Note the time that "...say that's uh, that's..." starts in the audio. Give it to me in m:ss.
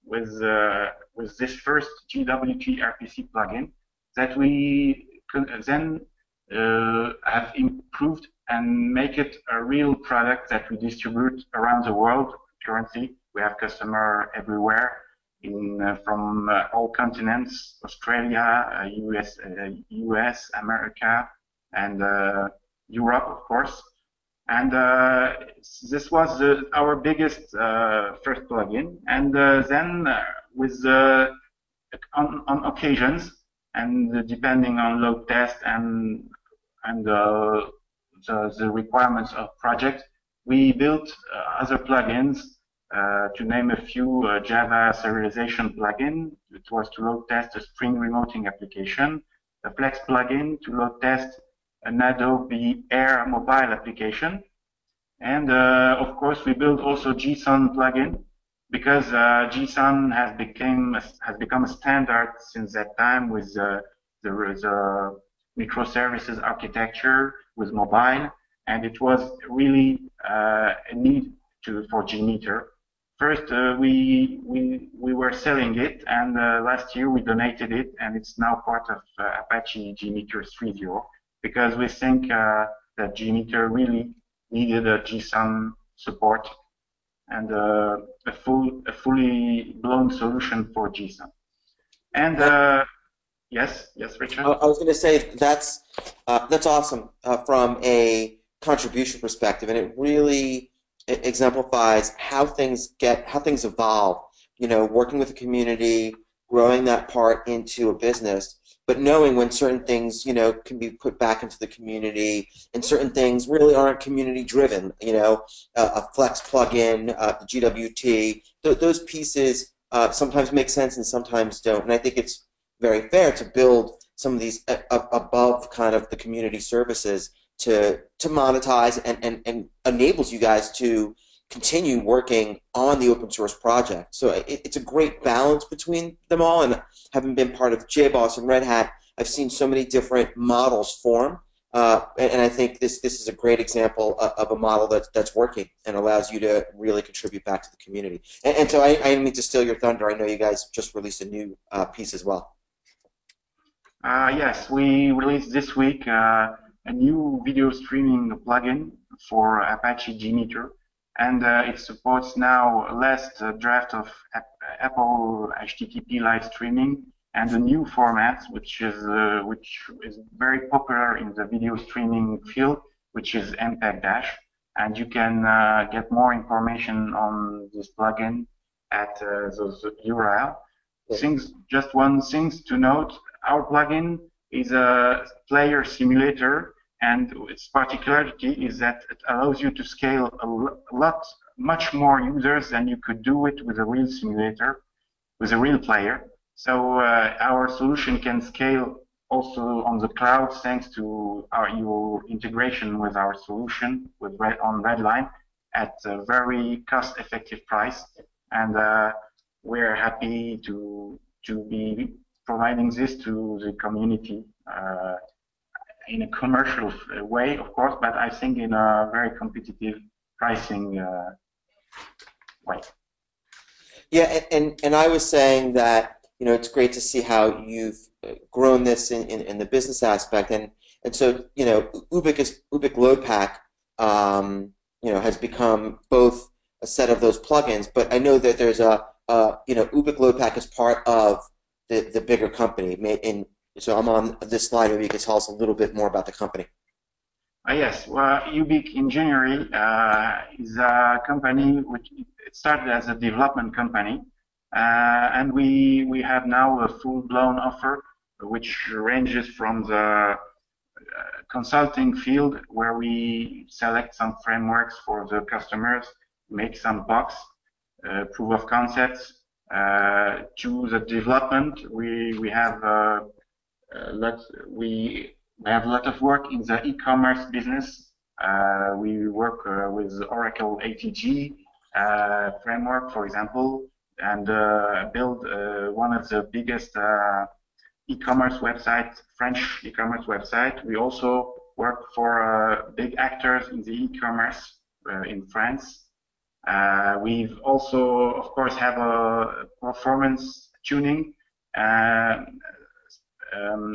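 1:34.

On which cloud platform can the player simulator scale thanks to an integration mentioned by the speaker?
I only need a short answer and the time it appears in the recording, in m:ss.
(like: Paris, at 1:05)
Redline, at 3:24.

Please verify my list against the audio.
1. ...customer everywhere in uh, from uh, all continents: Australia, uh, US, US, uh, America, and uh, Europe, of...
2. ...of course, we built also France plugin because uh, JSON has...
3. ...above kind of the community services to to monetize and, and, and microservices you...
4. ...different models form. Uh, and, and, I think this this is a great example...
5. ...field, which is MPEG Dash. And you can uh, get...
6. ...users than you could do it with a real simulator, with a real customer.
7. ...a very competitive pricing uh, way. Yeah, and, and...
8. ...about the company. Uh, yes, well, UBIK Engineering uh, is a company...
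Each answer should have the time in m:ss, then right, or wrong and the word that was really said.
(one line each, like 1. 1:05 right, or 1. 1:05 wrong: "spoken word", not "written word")
1. 0:13 right
2. 0:55 wrong: "JSON", not "France"
3. 2:04 wrong: "enables", not "microservices"
4. 2:19 right
5. 2:52 right
6. 3:12 wrong: "player", not "customer"
7. 3:38 right
8. 4:06 right.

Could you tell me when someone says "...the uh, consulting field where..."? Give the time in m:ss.
4:19.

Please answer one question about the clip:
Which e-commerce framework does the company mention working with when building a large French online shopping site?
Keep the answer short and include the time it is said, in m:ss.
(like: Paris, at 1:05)
Oracle ATG, at 4:40.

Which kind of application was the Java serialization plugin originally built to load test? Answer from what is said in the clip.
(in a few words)
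Spring remoting application.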